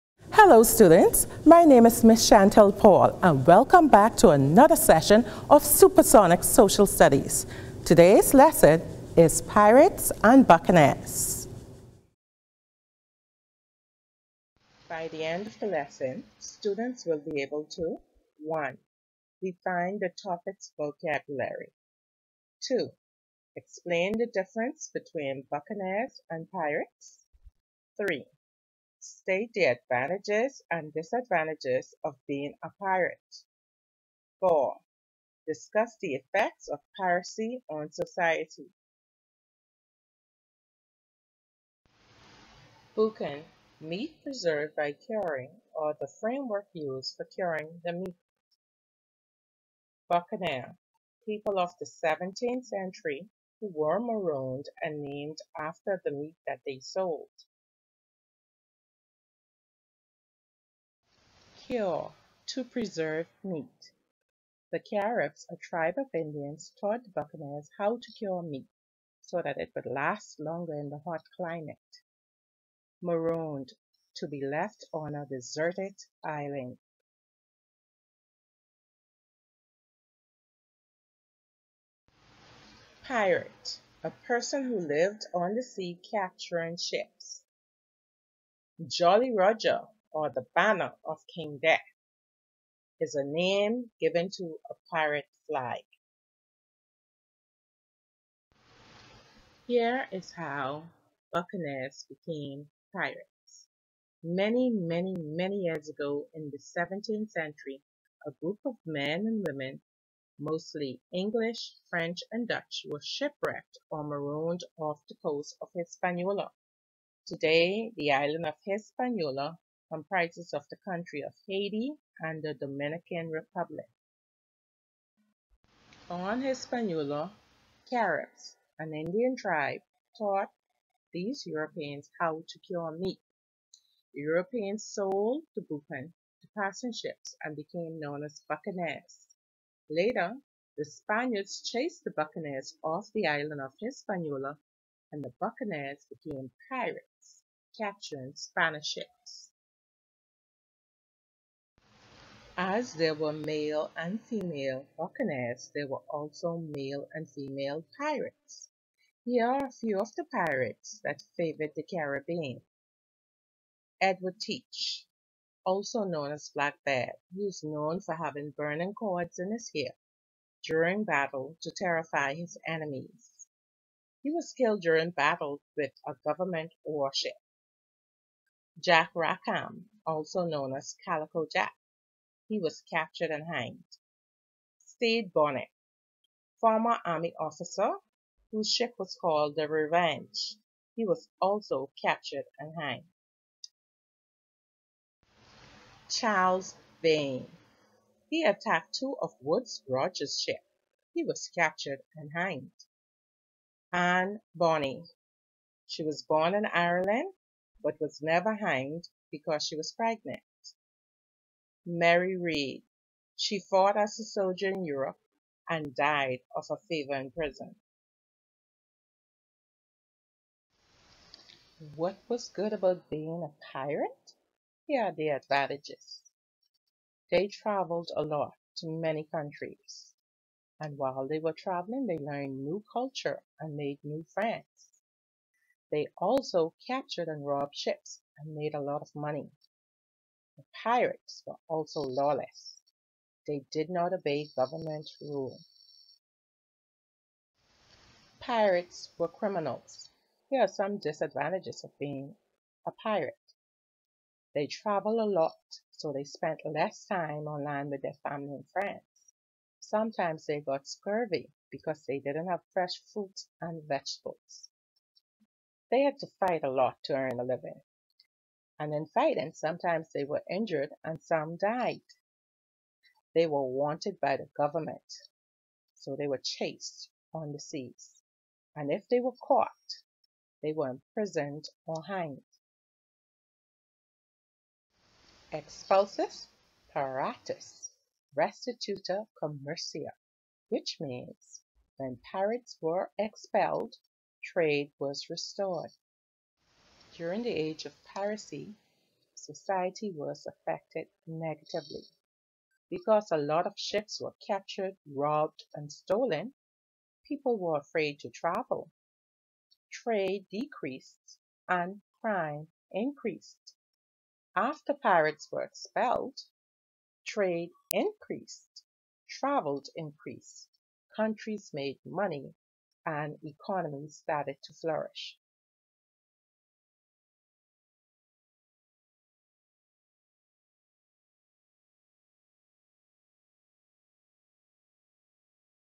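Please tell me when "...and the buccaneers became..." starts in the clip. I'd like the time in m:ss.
2:25.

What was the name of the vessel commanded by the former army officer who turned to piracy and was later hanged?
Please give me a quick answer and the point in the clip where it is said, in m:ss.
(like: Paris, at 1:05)
the Revenge, at 3:09.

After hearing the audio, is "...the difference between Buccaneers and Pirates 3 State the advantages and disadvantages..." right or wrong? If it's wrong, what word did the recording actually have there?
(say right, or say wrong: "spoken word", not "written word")
right.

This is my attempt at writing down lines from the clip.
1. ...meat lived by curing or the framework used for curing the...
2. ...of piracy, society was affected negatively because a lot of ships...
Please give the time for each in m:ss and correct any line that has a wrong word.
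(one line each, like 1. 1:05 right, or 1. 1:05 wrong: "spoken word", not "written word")
1. 0:43 wrong: "preserved", not "lived"
2. 4:57 right.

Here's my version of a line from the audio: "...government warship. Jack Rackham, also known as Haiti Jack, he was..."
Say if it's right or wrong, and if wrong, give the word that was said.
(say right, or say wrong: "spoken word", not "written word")
wrong: "Calico", not "Haiti".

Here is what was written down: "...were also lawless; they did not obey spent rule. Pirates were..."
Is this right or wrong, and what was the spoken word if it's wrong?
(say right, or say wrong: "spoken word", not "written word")
wrong: "government", not "spent".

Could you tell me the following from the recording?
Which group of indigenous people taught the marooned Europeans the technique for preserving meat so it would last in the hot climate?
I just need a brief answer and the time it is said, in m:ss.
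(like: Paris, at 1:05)
The Caribs, at 1:04.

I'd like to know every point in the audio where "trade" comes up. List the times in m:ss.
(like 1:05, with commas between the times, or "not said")
4:54, 5:09, 5:17.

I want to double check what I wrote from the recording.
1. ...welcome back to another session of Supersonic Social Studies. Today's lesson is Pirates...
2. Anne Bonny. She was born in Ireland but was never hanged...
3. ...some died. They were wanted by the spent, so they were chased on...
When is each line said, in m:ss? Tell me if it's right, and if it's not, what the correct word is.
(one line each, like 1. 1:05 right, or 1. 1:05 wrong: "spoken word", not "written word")
1. 0:03 right
2. 3:23 right
3. 4:31 wrong: "government", not "spent".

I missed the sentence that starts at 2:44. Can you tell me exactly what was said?
Edward Teach, also known as Blackbeard, he is known for having burning cords in his hair during battle to terrify his enemies.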